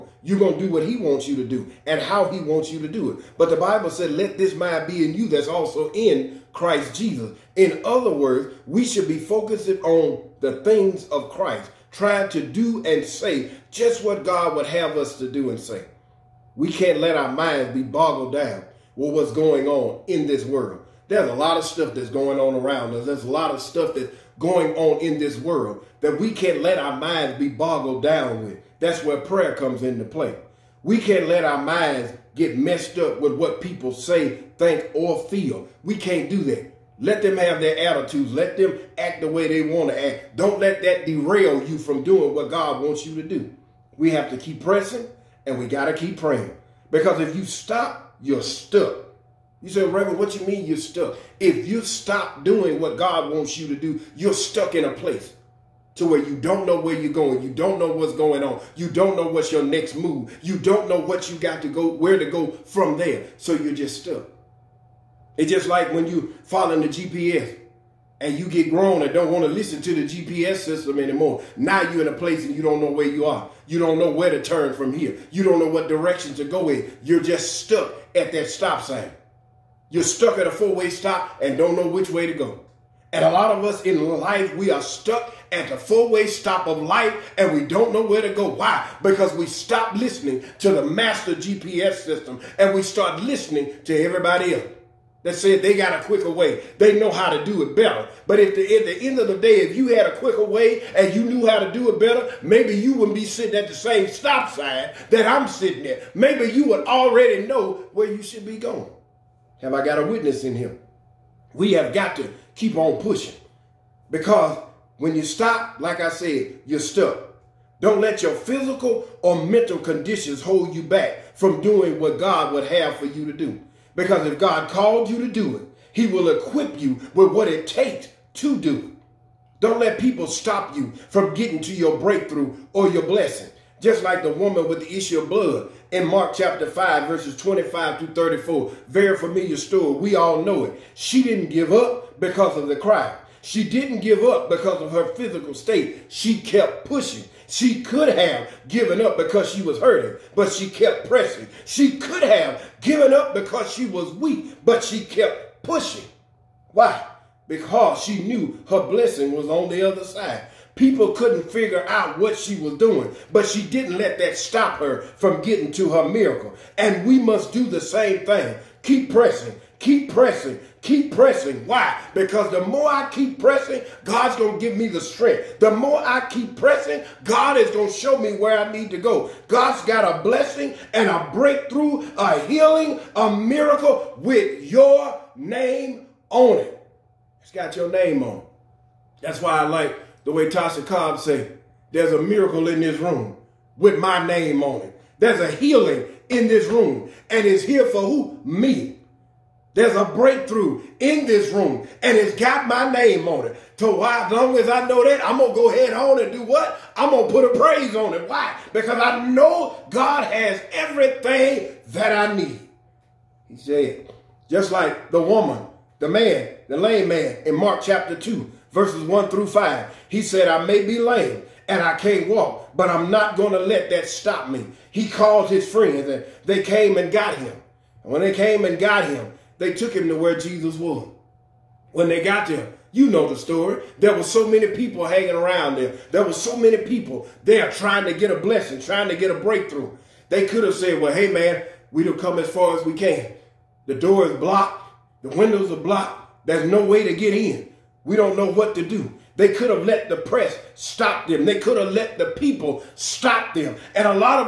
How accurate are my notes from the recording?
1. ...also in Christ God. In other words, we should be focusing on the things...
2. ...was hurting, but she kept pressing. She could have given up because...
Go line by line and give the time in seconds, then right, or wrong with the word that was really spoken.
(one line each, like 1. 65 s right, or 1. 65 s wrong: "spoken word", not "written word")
1. 5 s wrong: "Jesus", not "God"
2. 149 s right.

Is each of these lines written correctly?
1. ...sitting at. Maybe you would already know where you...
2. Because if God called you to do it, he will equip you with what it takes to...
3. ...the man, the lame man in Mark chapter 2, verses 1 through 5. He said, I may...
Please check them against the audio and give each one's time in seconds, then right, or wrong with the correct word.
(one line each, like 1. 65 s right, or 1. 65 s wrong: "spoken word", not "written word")
1. 105 s right
2. 123 s right
3. 215 s right.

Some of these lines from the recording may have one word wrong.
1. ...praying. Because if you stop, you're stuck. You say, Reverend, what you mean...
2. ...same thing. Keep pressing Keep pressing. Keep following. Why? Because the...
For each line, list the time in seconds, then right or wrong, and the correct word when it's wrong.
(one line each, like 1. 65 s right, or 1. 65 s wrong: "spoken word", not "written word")
1. 46 s right
2. 167 s wrong: "pressing", not "following".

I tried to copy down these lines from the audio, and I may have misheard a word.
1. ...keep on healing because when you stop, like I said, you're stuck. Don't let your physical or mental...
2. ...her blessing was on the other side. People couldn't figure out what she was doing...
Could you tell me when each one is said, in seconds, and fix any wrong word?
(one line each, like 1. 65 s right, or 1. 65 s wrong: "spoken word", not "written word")
1. 112 s wrong: "pushing", not "healing"
2. 158 s right.